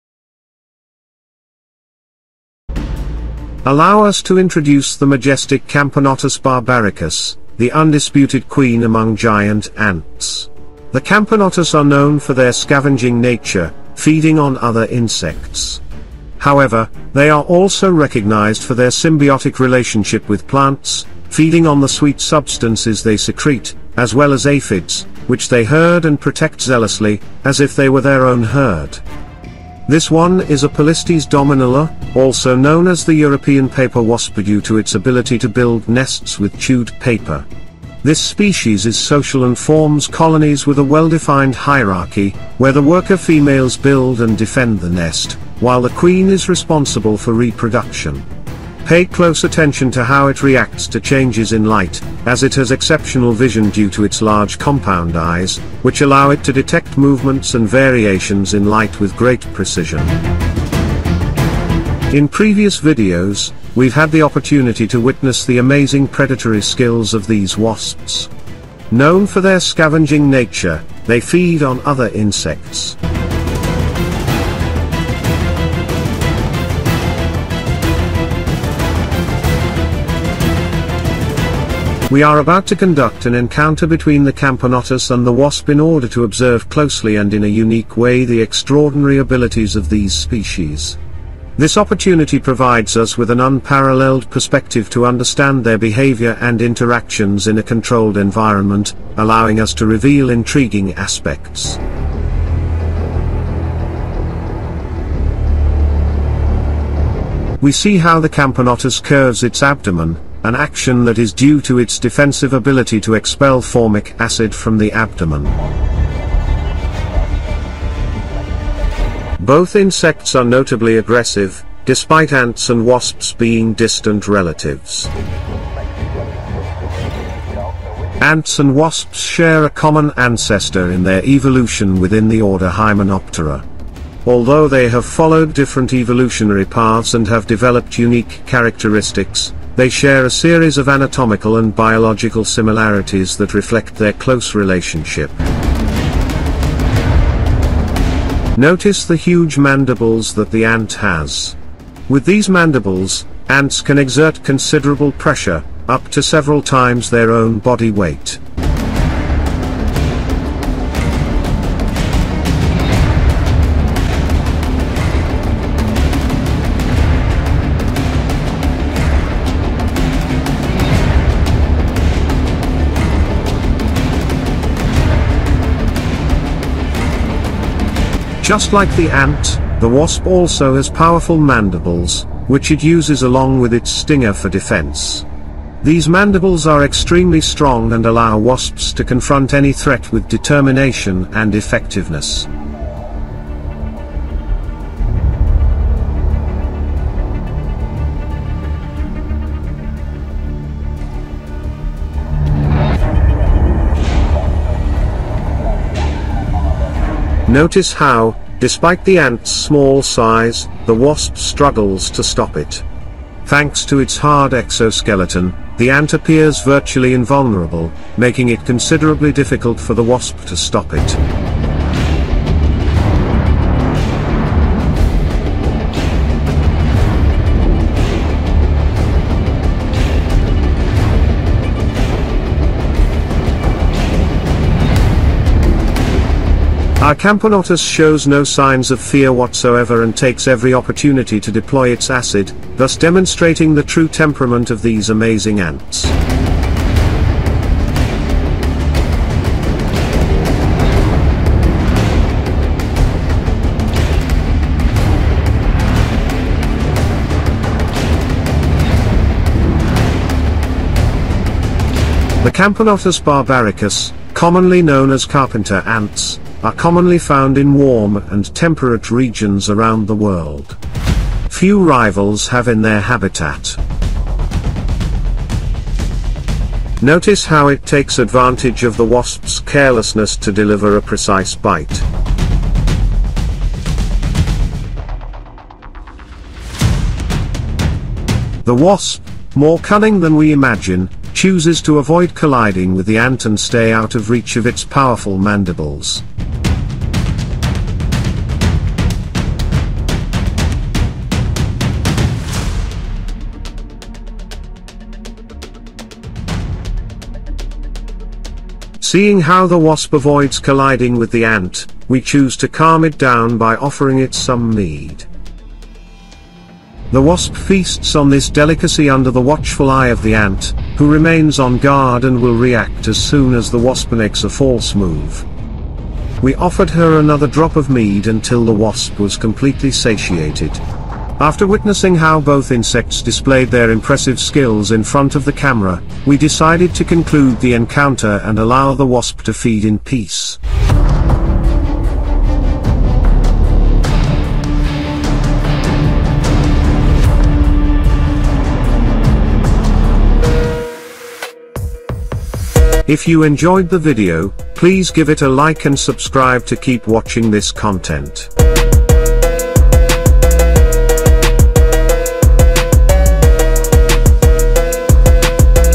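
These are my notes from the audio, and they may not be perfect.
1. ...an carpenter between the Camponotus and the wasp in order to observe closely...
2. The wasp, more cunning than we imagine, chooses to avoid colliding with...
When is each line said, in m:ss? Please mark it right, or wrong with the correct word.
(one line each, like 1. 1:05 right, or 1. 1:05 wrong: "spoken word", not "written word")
1. 1:23 wrong: "encounter", not "carpenter"
2. 4:48 right.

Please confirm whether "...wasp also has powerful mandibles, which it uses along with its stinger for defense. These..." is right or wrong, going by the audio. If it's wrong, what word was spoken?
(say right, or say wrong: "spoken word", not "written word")
right.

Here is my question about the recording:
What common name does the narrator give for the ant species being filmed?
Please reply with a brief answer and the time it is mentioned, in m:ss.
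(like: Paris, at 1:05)
carpenter ants, at 4:25.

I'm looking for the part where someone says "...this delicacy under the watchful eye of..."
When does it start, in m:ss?
5:18.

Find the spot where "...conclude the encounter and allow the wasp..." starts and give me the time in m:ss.
5:37.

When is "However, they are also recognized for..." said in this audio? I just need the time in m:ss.
0:16.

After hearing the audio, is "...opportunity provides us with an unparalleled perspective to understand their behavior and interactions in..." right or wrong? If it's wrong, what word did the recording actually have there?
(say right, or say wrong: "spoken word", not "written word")
right.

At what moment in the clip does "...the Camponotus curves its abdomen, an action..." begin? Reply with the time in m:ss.
1:48.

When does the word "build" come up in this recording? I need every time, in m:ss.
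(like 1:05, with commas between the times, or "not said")
0:35, 0:43.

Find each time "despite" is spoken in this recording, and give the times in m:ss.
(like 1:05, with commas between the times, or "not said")
2:01, 3:28.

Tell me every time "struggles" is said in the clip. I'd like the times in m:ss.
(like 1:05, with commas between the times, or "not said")
3:31.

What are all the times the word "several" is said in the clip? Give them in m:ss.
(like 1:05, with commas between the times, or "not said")
2:36.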